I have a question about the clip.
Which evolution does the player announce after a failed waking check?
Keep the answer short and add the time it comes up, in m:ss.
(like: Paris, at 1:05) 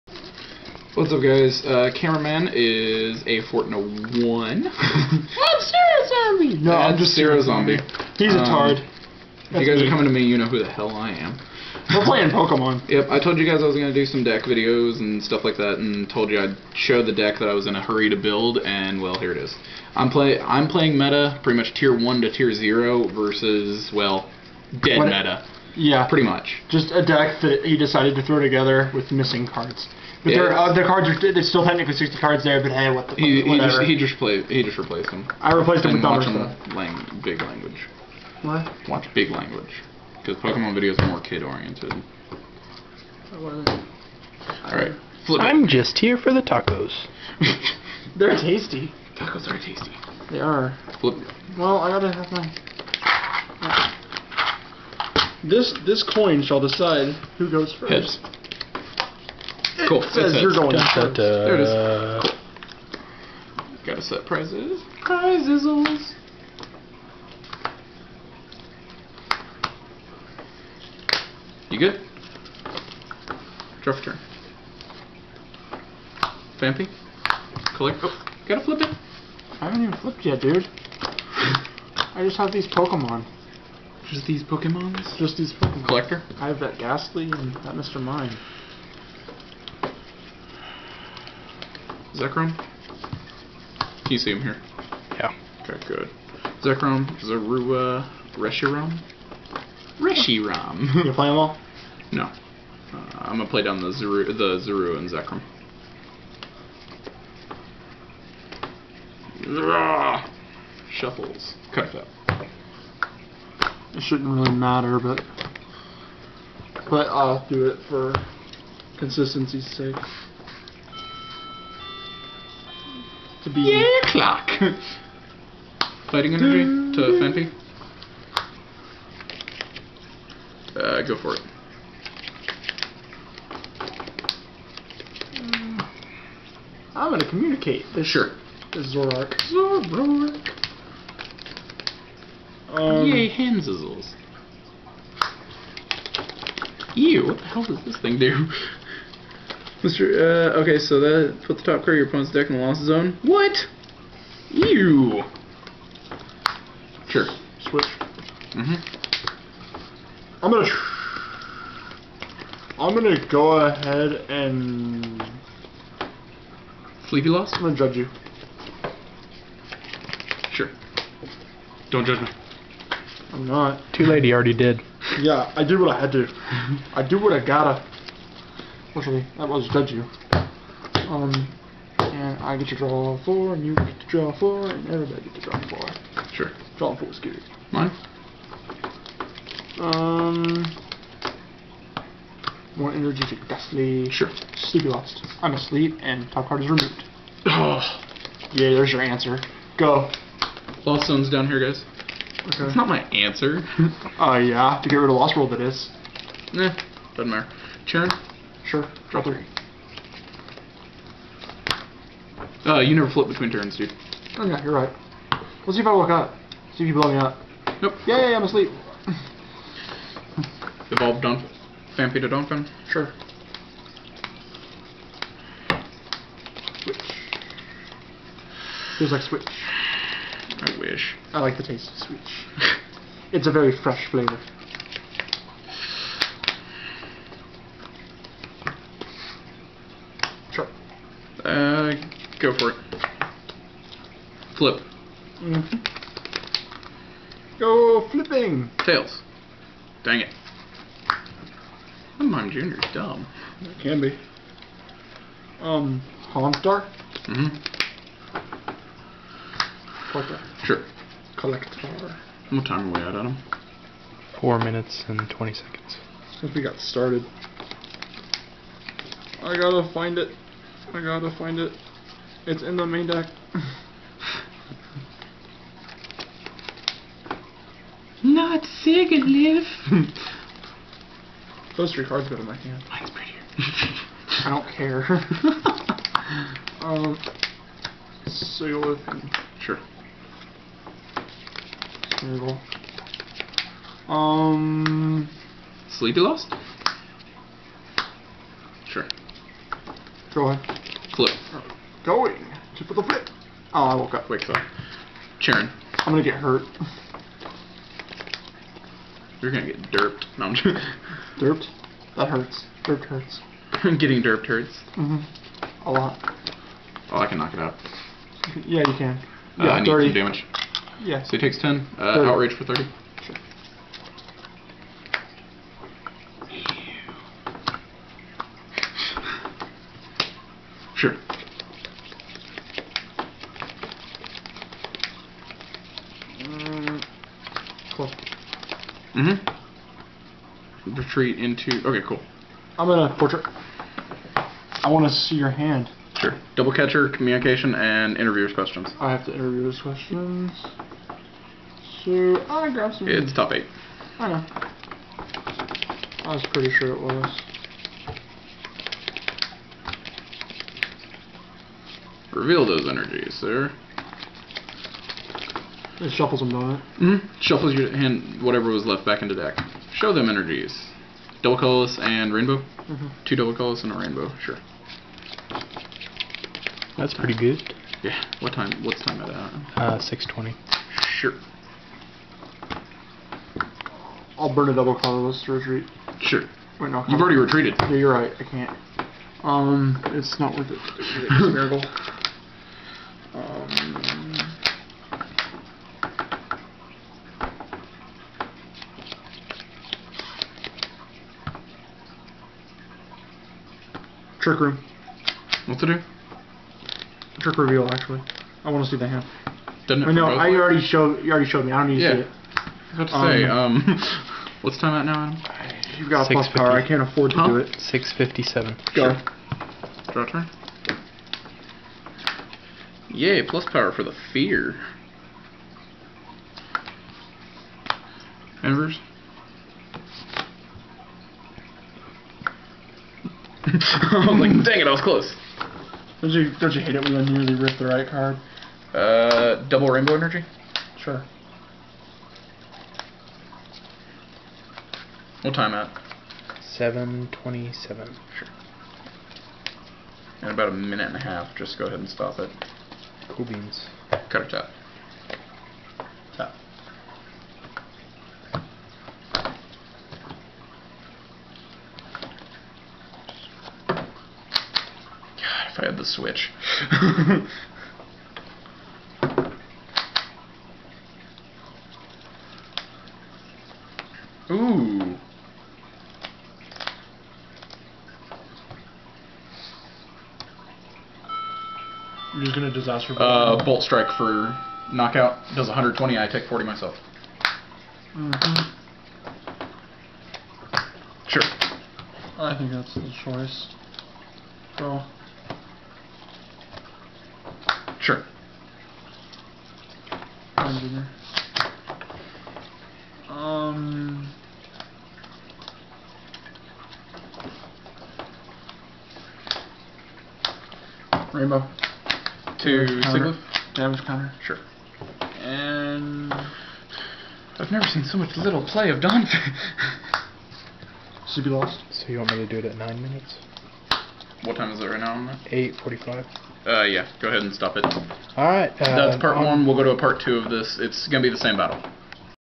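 Phanpy to Donphan, at 3:41.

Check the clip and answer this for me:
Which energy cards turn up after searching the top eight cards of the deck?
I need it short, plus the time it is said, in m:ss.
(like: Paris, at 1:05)
Two double colorless and a rainbow, at 6:13.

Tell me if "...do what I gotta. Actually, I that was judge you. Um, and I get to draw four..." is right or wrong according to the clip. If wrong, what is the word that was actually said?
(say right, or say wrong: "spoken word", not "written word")
right.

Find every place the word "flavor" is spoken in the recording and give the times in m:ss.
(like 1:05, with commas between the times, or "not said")
3:54.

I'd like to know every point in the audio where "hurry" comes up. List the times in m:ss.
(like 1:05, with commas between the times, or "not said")
0:17.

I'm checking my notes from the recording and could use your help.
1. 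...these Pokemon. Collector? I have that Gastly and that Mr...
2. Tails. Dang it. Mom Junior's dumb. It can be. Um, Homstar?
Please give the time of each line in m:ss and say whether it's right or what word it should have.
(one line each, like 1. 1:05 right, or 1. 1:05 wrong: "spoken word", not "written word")
1. 1:25 right
2. 4:08 right.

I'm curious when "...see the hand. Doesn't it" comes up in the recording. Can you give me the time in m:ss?
6:48.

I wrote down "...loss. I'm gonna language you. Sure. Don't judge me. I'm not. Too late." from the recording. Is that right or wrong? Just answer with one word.
wrong.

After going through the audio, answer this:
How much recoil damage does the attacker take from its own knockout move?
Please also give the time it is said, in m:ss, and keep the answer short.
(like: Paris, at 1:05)
40, at 8:06.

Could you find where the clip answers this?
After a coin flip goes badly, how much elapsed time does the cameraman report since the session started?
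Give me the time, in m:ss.
4:24.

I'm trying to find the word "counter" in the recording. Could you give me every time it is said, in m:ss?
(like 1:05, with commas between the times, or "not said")
8:34.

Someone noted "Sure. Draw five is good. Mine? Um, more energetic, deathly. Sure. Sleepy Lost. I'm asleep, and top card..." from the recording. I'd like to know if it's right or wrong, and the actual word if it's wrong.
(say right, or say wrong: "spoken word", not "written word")
wrong: "four", not "five".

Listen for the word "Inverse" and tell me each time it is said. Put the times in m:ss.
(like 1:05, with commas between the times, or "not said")
7:08.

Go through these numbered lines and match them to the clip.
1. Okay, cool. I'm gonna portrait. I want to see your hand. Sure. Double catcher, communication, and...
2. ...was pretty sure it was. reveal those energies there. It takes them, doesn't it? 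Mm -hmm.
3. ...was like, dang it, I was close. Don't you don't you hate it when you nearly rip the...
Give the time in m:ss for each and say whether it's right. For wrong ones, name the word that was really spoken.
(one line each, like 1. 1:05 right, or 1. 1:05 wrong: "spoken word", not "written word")
1. 5:41 right
2. 5:56 wrong: "shuffles", not "takes"
3. 7:14 right.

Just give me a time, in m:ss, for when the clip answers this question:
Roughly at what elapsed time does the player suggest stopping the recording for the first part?
8:42.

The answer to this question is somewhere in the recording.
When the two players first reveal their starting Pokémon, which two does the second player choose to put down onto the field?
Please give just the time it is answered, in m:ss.
1:44.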